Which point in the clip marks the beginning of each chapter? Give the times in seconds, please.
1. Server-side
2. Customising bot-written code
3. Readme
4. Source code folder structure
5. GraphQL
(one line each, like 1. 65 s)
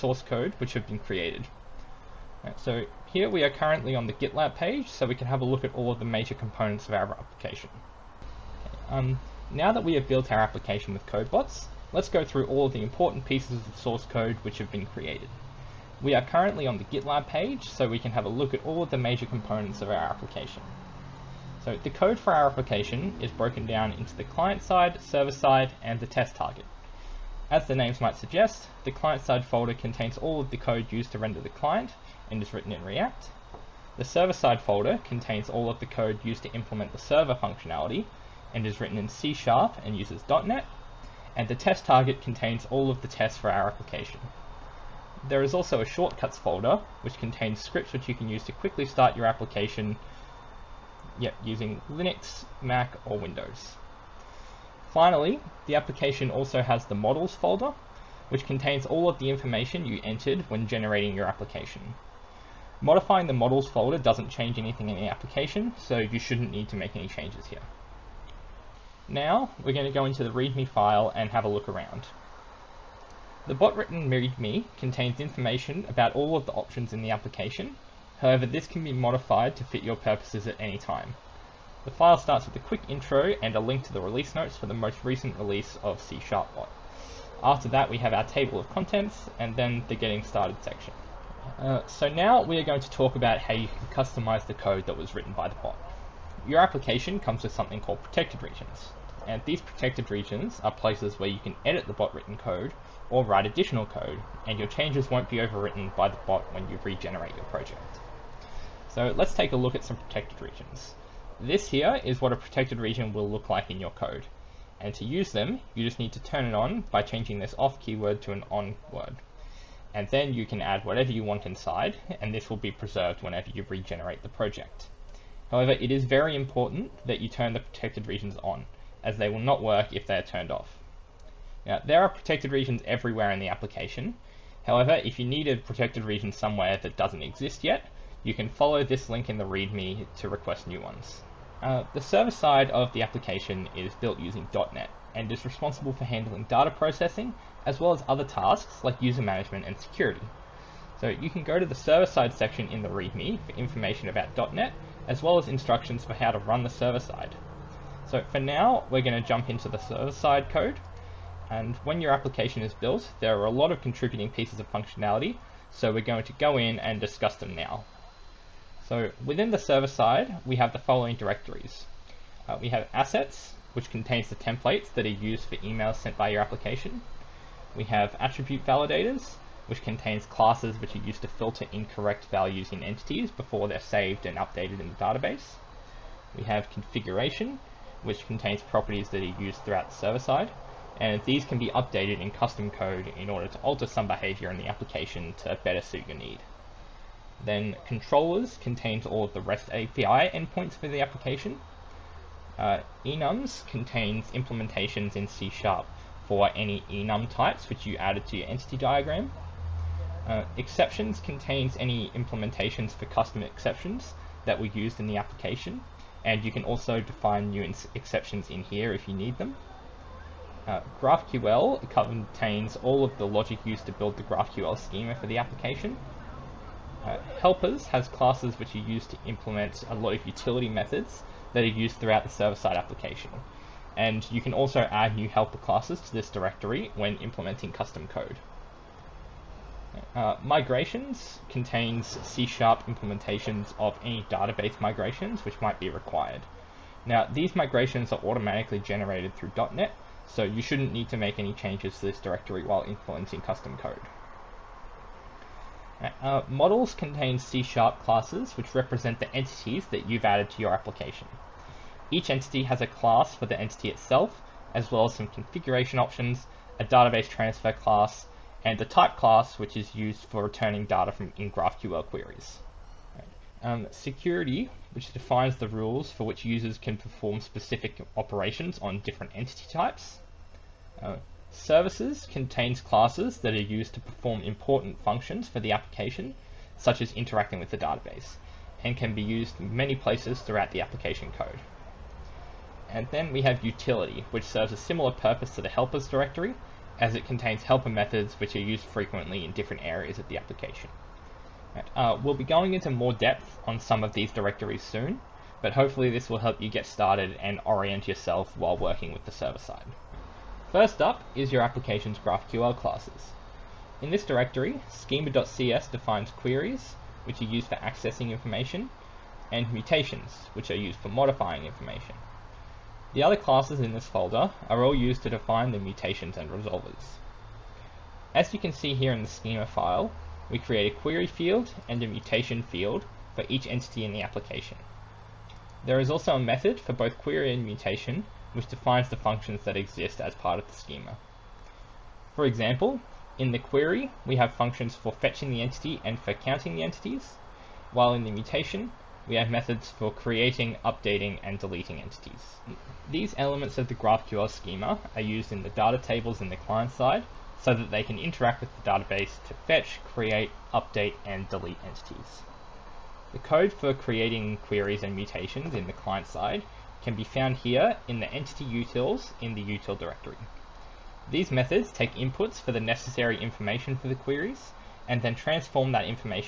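1. 141 s
2. 91 s
3. 68 s
4. 21 s
5. 310 s.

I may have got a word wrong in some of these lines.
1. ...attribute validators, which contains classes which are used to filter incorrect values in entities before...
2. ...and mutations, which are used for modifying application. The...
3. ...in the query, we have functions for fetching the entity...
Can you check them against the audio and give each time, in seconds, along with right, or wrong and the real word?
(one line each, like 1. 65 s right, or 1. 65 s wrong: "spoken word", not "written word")
1. 178 s right
2. 319 s wrong: "information", not "application"
3. 343 s right.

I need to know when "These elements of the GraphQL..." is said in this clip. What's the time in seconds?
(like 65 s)
353 s.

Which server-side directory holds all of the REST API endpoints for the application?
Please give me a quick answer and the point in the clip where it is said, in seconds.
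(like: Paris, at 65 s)
controllers, at 197 s.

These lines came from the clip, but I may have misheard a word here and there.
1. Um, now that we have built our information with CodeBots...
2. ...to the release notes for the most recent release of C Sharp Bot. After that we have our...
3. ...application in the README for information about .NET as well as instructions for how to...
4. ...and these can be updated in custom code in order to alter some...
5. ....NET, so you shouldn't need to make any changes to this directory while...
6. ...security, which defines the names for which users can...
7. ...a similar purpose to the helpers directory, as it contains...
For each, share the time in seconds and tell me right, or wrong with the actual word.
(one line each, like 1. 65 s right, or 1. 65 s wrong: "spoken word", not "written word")
1. 8 s wrong: "application", not "information"
2. 83 s right
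3. 152 s wrong: "section", not "application"
4. 191 s right
5. 249 s right
6. 273 s wrong: "rules", not "names"
7. 294 s right.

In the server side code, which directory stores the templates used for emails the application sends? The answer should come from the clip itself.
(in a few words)
assets.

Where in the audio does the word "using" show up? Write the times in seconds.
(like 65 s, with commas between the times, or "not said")
51 s, 144 s.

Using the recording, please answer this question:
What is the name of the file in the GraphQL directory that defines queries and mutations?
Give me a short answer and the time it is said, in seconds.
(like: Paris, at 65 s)
schema.cs, at 314 s.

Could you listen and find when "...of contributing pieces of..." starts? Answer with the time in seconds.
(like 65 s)
163 s.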